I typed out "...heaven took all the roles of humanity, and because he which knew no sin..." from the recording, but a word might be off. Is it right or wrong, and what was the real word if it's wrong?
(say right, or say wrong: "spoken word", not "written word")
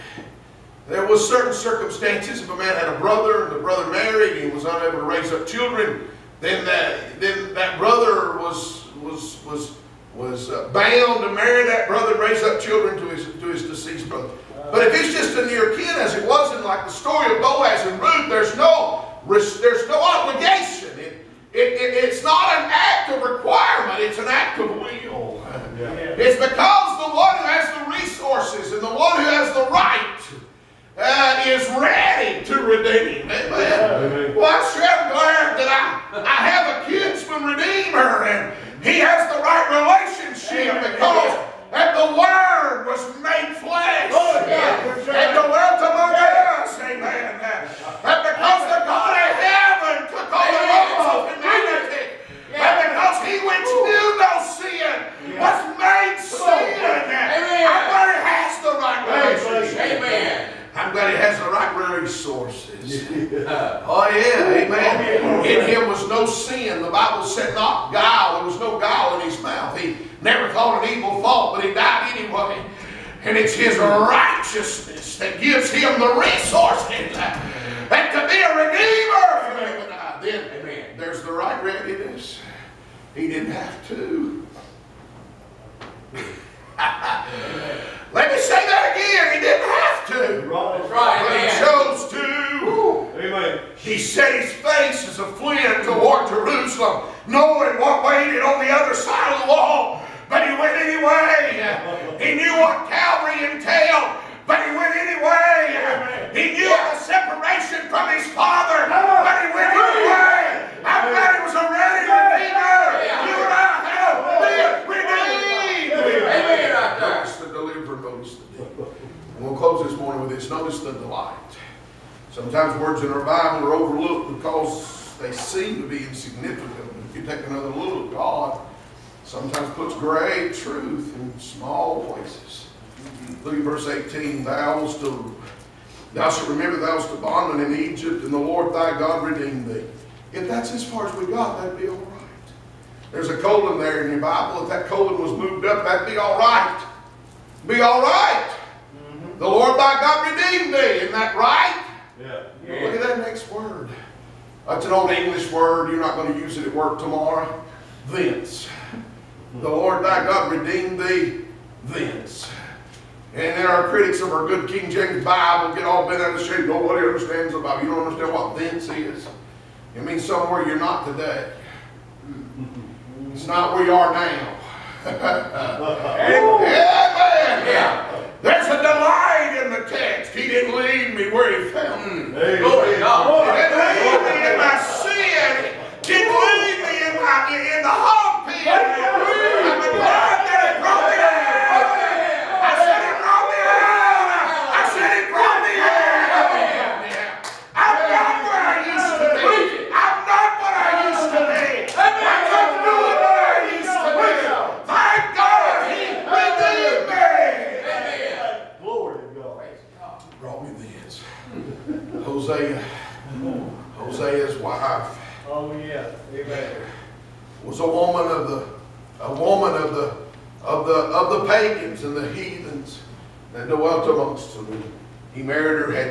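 right.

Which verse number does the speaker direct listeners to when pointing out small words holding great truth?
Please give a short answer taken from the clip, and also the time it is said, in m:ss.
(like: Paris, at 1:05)
18, at 2:13.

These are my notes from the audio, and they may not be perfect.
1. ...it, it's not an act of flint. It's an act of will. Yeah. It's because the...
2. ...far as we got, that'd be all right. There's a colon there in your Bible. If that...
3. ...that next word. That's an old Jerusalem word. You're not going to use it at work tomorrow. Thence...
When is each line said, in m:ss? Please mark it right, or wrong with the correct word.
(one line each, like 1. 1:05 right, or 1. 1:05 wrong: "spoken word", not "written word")
1. 0:21 wrong: "requirement", not "flint"
2. 2:20 right
3. 2:33 wrong: "English", not "Jerusalem".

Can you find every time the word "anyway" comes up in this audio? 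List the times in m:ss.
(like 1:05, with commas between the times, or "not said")
1:12, 1:40, 1:44, 1:49.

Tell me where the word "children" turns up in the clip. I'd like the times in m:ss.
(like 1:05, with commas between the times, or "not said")
0:05, 0:12.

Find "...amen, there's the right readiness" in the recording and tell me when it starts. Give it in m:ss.
1:20.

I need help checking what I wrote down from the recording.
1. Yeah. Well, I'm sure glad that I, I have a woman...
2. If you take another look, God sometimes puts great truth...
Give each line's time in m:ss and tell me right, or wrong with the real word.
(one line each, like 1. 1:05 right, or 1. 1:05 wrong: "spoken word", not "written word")
1. 0:33 wrong: "kinsman", not "woman"
2. 2:07 right.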